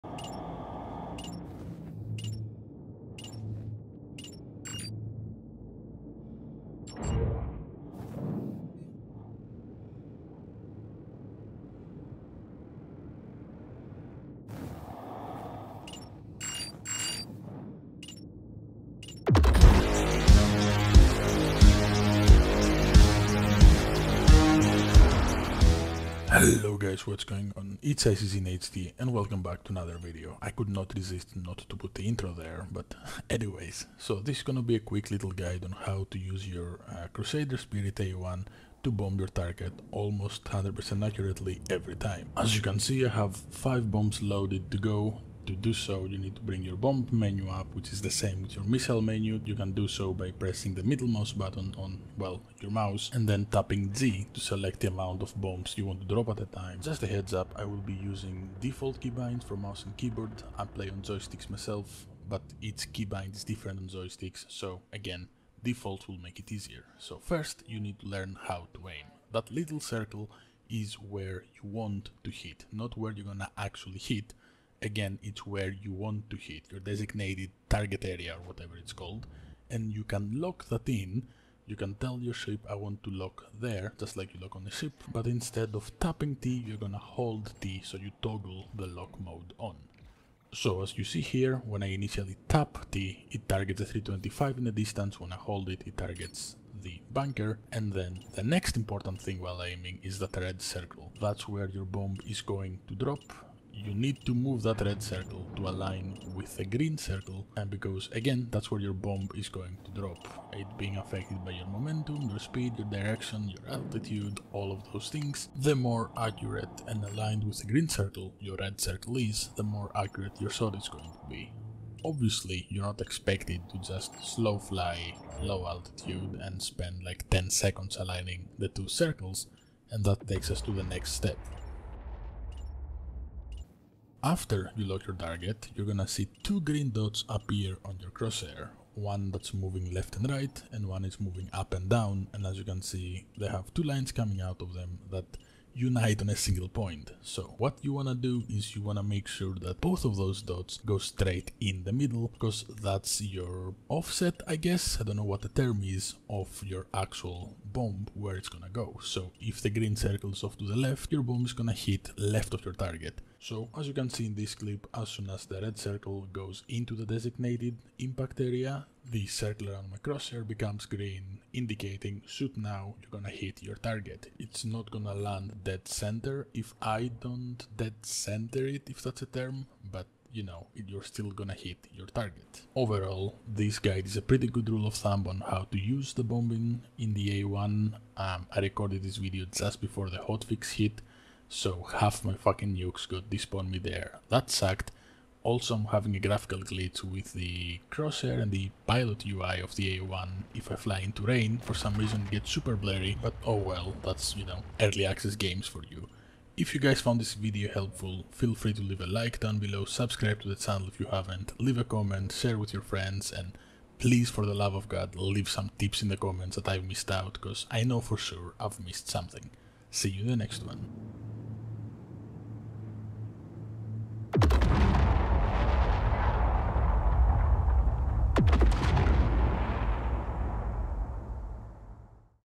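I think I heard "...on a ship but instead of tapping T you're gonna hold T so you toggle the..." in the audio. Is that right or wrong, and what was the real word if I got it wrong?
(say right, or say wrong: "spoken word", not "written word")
right.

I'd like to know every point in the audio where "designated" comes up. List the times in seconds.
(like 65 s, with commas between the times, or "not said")
76 s, 167 s.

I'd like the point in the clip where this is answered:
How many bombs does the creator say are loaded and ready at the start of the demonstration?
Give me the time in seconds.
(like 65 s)
43 s.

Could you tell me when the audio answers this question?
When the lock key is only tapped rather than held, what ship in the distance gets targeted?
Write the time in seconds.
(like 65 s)
93 s.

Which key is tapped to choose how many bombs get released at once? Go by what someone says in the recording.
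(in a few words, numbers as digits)
Z.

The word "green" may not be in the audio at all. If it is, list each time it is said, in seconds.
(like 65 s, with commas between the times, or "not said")
106 s, 117 s, 136 s, 159 s, 170 s.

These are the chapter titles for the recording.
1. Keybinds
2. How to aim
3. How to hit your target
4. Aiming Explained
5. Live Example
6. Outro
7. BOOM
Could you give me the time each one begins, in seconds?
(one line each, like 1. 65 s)
1. 25 s
2. 66 s
3. 97 s
4. 122 s
5. 162 s
6. 182 s
7. 223 s.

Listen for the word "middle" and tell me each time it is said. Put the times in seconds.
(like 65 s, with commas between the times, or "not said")
50 s, 151 s.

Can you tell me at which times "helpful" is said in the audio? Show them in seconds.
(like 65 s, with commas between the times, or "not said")
207 s.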